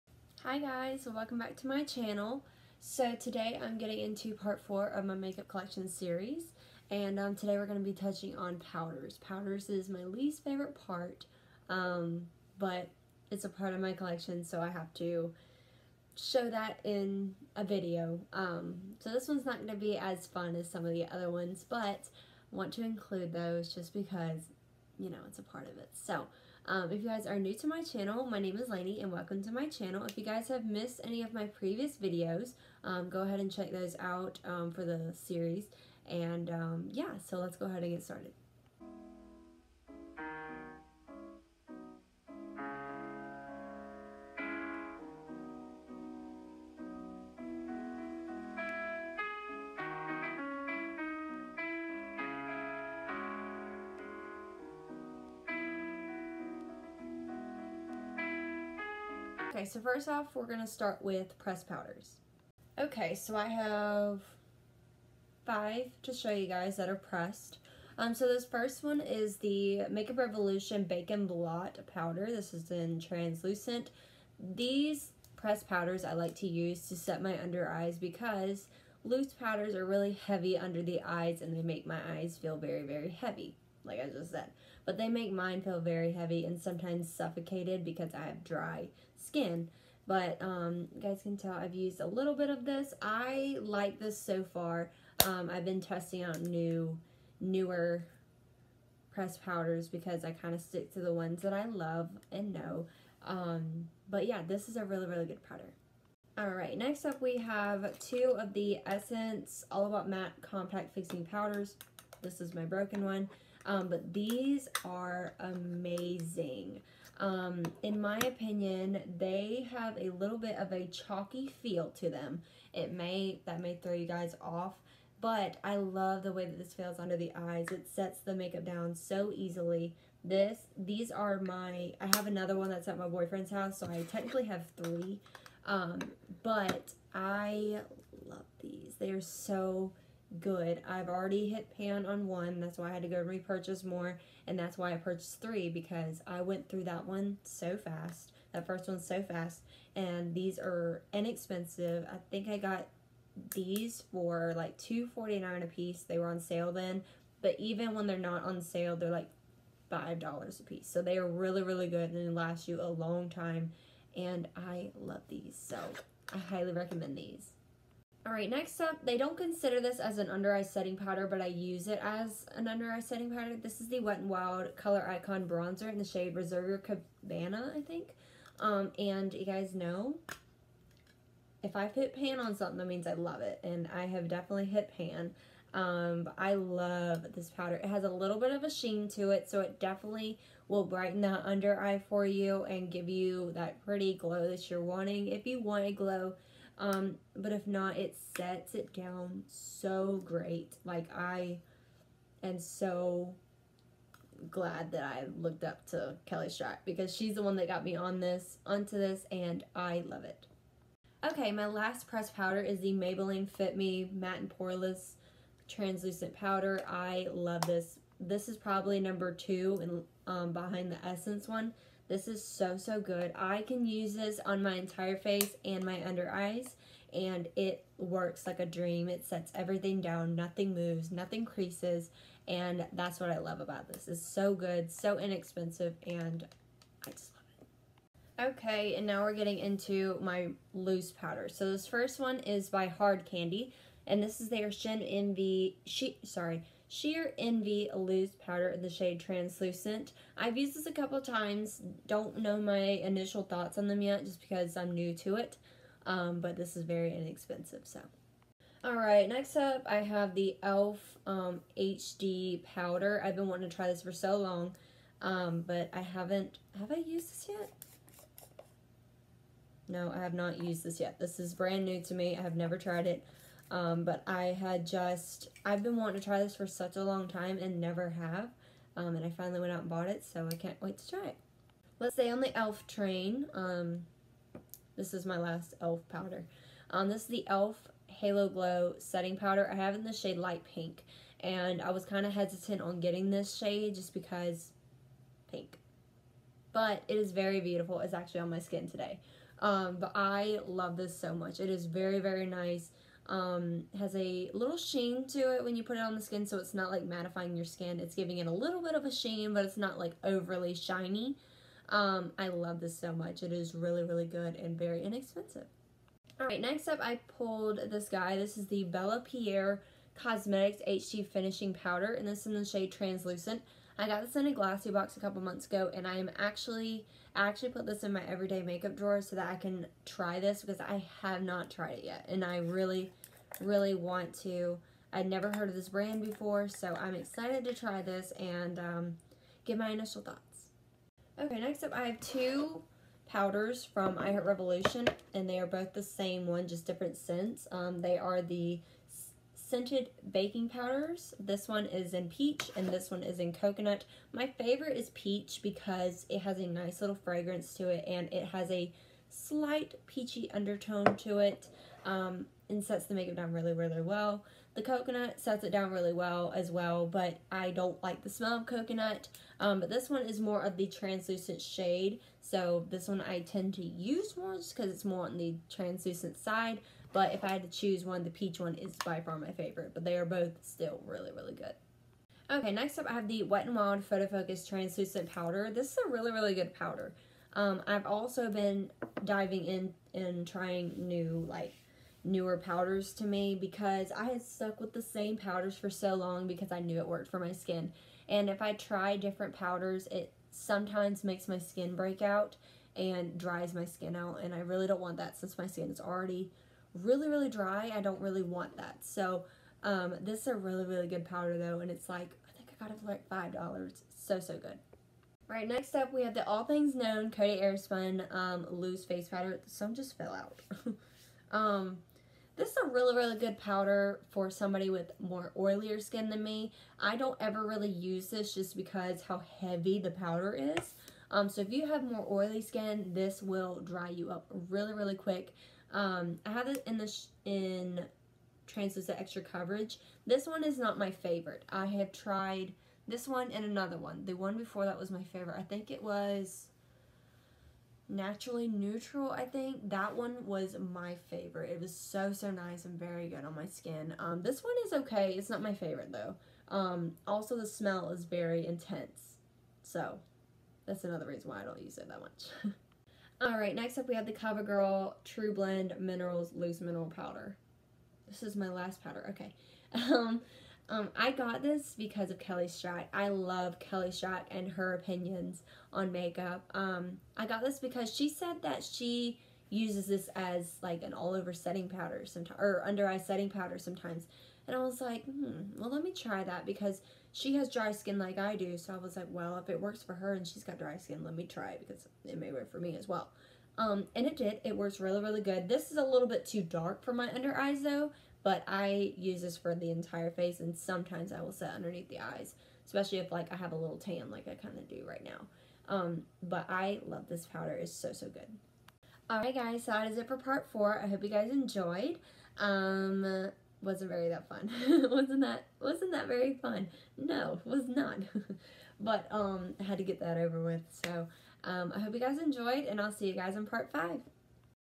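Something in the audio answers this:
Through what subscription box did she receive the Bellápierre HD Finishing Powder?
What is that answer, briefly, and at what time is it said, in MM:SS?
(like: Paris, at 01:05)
Glossybox, at 05:24.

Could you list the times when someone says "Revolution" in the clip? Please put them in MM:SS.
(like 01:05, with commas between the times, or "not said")
01:10, 05:44.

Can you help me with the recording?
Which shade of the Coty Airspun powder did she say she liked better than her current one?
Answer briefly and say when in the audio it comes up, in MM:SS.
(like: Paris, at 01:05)
Naturally Neutral, at 07:28.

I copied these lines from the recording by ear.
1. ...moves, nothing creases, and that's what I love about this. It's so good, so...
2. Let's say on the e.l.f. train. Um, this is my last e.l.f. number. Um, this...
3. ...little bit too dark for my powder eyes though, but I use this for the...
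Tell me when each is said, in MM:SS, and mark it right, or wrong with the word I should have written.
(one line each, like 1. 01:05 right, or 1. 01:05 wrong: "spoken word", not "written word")
1. 03:50 right
2. 04:41 wrong: "powder", not "number"
3. 08:16 wrong: "under", not "powder".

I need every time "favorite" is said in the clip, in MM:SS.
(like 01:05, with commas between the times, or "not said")
00:10, 05:54, 06:19, 07:21, 07:25, 07:31, 07:35.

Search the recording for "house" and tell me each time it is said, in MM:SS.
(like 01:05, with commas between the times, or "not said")
02:13.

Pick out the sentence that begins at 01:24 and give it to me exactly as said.
But they make mine feel very heavy and sometimes suffocated because I have dry skin.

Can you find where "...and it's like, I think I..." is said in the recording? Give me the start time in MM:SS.
06:51.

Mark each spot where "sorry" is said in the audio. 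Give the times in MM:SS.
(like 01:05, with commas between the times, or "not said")
04:06.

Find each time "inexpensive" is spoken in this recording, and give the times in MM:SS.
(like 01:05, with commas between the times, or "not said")
02:31, 03:55, 04:17, 05:15.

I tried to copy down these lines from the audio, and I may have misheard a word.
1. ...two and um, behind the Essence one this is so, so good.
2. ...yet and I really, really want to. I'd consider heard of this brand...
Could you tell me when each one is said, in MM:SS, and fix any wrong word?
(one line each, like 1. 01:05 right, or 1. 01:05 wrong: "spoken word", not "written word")
1. 03:39 right
2. 05:32 wrong: "never", not "consider".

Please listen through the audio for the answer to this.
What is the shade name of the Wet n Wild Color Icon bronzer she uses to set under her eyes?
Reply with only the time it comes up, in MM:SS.
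02:56.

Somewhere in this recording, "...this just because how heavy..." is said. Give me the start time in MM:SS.
07:08.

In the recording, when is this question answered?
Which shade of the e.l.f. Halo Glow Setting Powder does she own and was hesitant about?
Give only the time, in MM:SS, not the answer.
04:50.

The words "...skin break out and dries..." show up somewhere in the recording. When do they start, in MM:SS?
06:41.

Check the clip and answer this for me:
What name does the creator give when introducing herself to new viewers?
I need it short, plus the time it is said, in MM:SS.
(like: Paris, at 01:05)
Laney, at 00:28.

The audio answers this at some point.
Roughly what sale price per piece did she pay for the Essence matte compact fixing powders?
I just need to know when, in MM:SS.
02:34.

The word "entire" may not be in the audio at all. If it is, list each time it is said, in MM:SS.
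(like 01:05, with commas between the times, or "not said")
03:44, 08:19.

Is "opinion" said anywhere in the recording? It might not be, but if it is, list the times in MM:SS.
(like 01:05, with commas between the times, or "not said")
01:58, 07:54.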